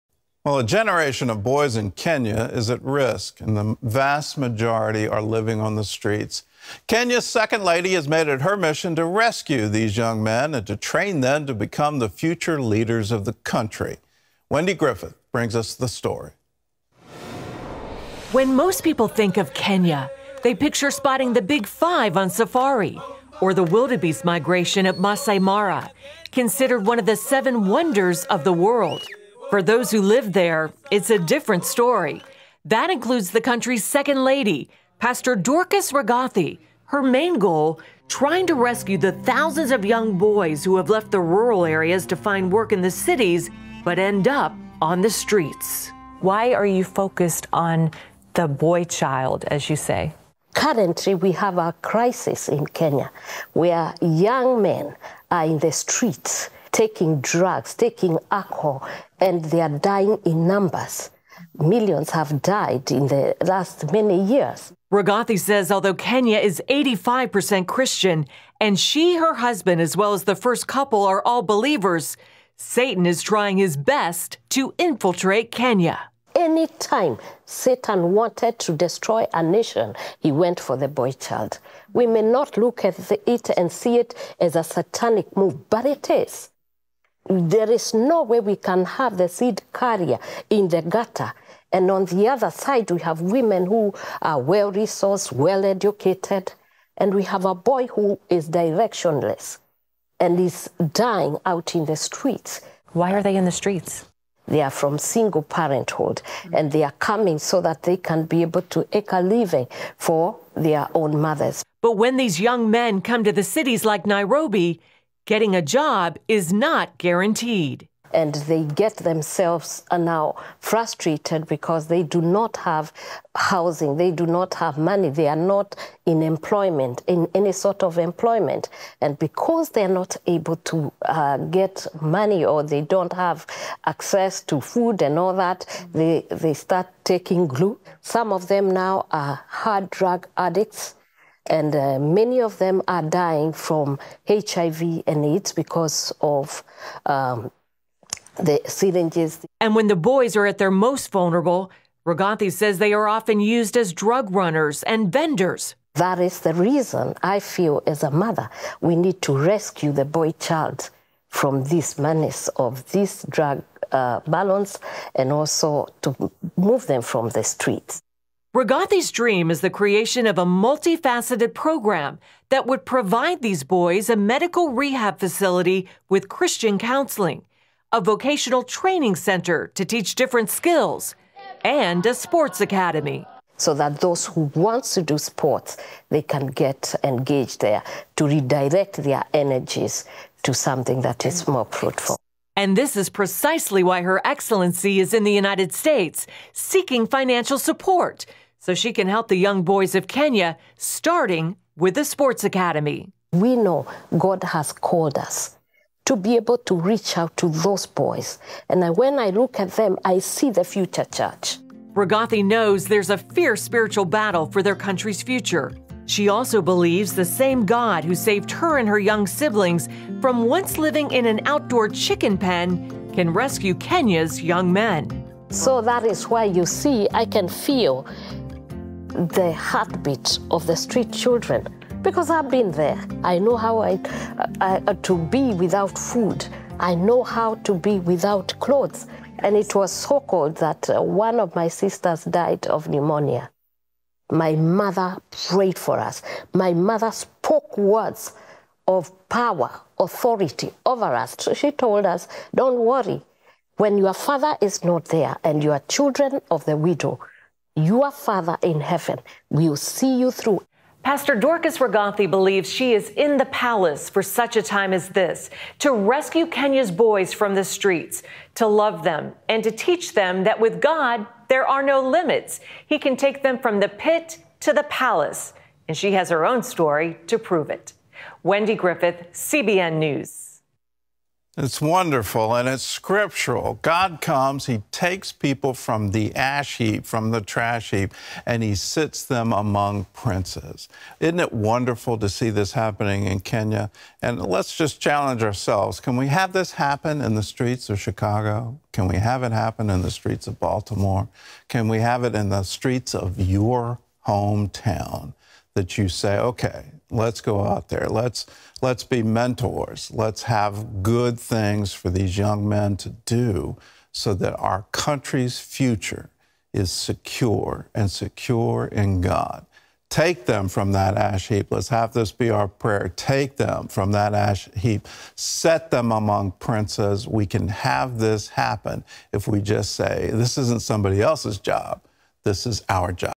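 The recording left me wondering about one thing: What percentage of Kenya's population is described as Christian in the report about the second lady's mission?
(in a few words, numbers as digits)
85%.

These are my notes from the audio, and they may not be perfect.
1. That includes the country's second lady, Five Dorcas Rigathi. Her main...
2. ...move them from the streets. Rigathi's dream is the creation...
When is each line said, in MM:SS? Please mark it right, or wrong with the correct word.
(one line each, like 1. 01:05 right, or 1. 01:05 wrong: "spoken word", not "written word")
1. 00:32 wrong: "Pastor", not "Five"
2. 02:46 right.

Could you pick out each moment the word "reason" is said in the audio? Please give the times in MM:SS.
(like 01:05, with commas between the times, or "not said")
02:36.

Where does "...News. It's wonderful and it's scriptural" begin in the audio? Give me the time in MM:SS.
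04:39.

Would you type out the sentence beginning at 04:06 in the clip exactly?
My mother spoke words of power, authority over us.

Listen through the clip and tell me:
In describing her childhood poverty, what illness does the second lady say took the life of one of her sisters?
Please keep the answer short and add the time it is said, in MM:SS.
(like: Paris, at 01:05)
Pneumonia, at 04:02.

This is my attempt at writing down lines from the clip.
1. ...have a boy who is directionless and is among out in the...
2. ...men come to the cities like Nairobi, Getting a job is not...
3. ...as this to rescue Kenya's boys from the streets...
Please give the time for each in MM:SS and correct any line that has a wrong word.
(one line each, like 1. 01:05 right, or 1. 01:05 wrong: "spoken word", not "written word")
1. 01:37 wrong: "dying", not "among"
2. 01:52 right
3. 04:24 right.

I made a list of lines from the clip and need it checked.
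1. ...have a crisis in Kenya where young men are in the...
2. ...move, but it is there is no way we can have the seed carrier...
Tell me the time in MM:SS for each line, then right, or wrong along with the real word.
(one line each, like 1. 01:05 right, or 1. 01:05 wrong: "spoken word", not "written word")
1. 00:51 right
2. 01:25 right.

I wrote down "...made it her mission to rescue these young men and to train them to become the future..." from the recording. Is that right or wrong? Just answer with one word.
right.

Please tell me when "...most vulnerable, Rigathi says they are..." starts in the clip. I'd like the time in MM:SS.
02:30.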